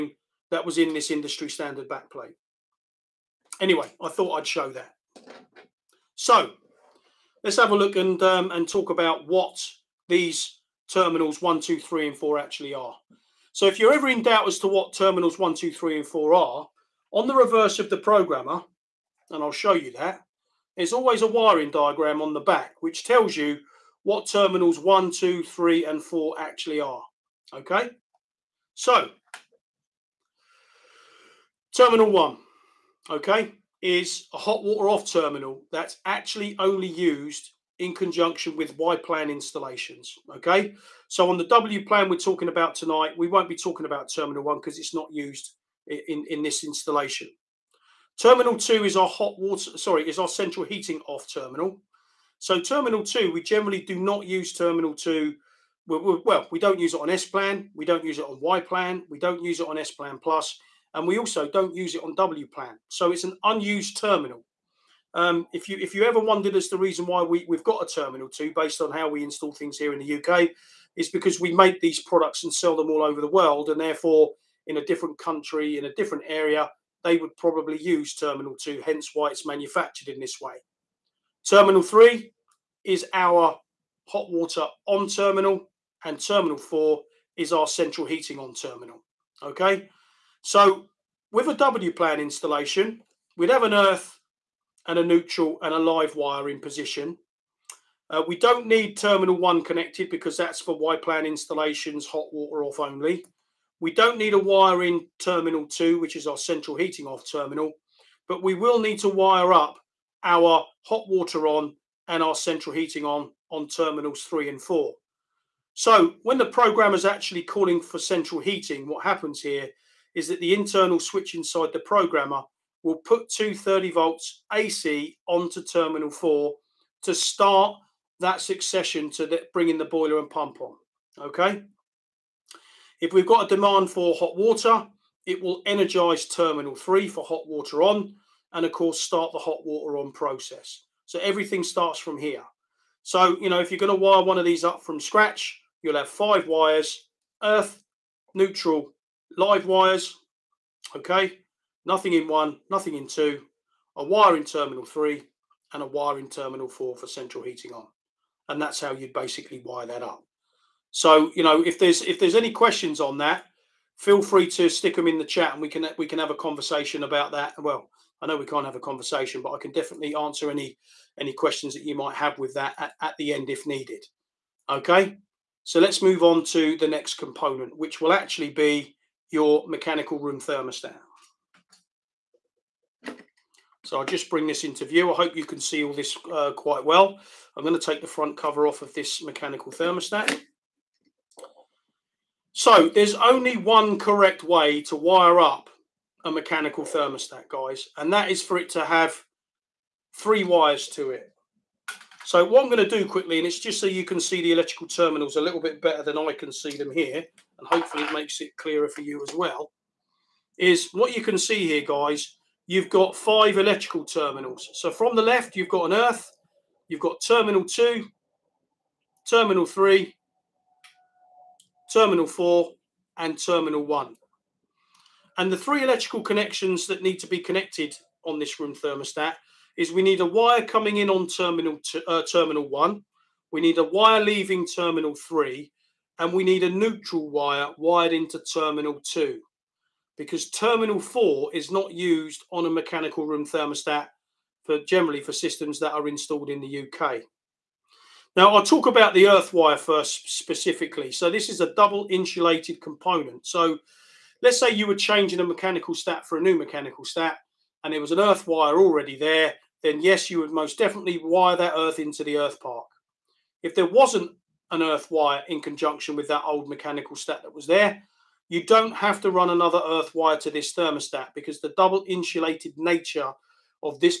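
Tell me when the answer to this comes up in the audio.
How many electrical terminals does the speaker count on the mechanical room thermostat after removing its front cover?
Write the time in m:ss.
3:33.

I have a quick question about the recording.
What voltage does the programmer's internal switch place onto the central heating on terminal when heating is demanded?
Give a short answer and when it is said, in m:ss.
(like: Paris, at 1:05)
230 volts AC, at 2:03.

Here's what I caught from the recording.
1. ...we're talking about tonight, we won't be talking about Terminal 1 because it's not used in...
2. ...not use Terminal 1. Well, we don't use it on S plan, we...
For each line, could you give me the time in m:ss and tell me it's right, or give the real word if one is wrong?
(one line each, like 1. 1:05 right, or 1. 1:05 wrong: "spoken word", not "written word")
1. 0:42 right
2. 0:53 wrong: "2", not "1".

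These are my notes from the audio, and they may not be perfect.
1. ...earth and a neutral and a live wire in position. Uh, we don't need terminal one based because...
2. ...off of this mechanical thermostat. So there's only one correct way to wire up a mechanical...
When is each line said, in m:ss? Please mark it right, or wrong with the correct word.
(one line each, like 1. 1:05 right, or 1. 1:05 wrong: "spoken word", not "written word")
1. 1:33 wrong: "connected", not "based"
2. 3:08 right.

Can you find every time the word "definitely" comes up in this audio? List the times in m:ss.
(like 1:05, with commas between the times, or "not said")
2:49, 4:20.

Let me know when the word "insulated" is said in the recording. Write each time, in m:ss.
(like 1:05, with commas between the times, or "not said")
4:12, 4:32.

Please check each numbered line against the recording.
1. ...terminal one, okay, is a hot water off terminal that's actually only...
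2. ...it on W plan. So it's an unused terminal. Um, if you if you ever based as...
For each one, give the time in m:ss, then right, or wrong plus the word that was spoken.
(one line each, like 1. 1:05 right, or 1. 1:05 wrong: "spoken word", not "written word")
1. 0:31 right
2. 1:01 wrong: "wondered", not "based".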